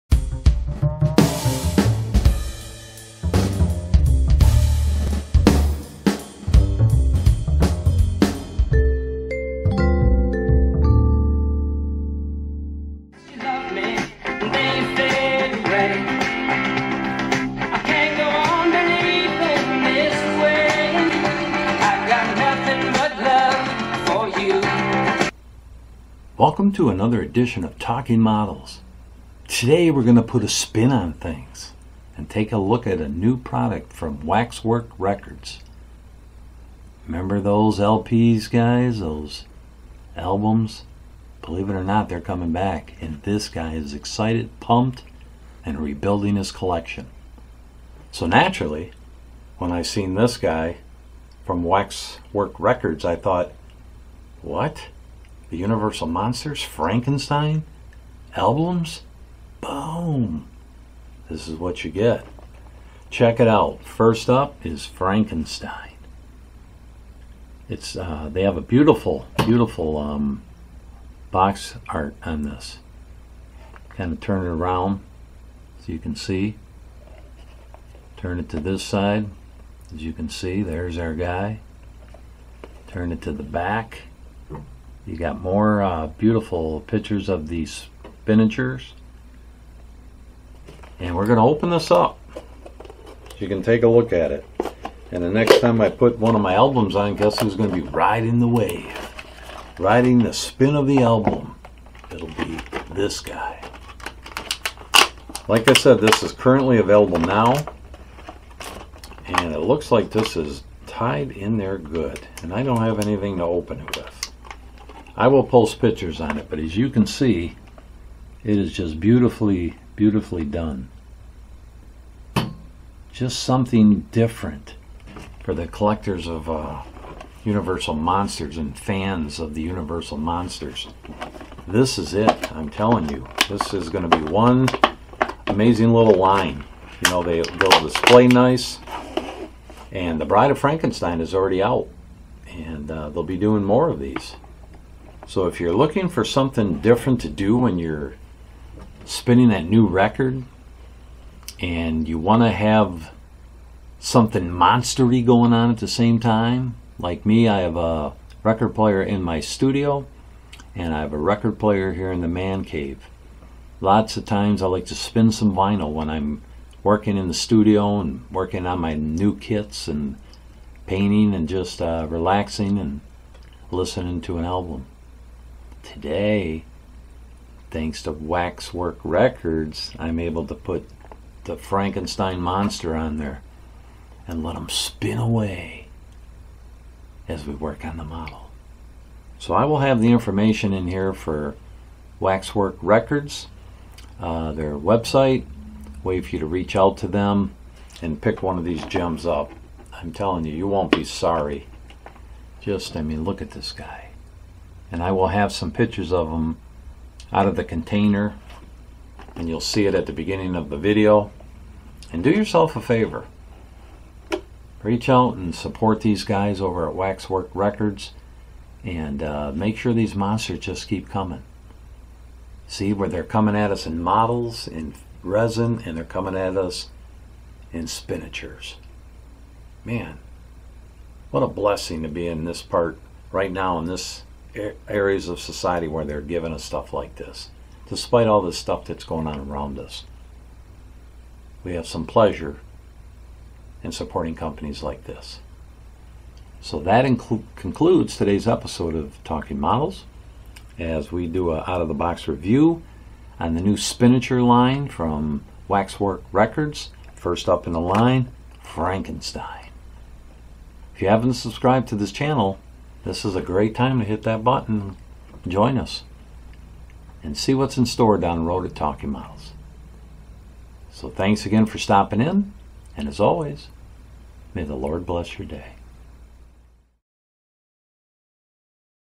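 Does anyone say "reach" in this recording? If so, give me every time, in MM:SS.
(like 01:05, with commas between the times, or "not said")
03:16, 03:34.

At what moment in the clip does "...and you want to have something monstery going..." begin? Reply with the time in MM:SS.
02:31.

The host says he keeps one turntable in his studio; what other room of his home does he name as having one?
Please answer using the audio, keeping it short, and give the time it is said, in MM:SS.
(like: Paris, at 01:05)
man cave, at 02:42.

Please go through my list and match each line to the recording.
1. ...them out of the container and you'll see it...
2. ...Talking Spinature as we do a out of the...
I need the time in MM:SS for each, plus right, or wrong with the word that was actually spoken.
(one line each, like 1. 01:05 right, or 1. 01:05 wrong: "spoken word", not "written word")
1. 03:26 right
2. 04:09 wrong: "Models", not "Spinature".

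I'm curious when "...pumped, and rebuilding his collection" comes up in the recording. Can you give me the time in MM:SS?
00:44.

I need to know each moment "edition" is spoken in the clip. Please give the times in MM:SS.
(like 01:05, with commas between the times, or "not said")
00:27.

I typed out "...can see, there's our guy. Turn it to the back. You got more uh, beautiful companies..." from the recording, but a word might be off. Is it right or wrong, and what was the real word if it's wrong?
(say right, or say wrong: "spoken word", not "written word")
wrong: "pictures", not "companies".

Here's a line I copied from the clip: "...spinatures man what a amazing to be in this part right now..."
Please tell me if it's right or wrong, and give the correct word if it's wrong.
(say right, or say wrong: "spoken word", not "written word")
wrong: "blessing", not "amazing".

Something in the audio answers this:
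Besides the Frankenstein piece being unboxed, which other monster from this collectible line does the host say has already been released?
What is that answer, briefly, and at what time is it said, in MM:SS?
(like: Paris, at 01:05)
The Bride of Frankenstein, at 02:20.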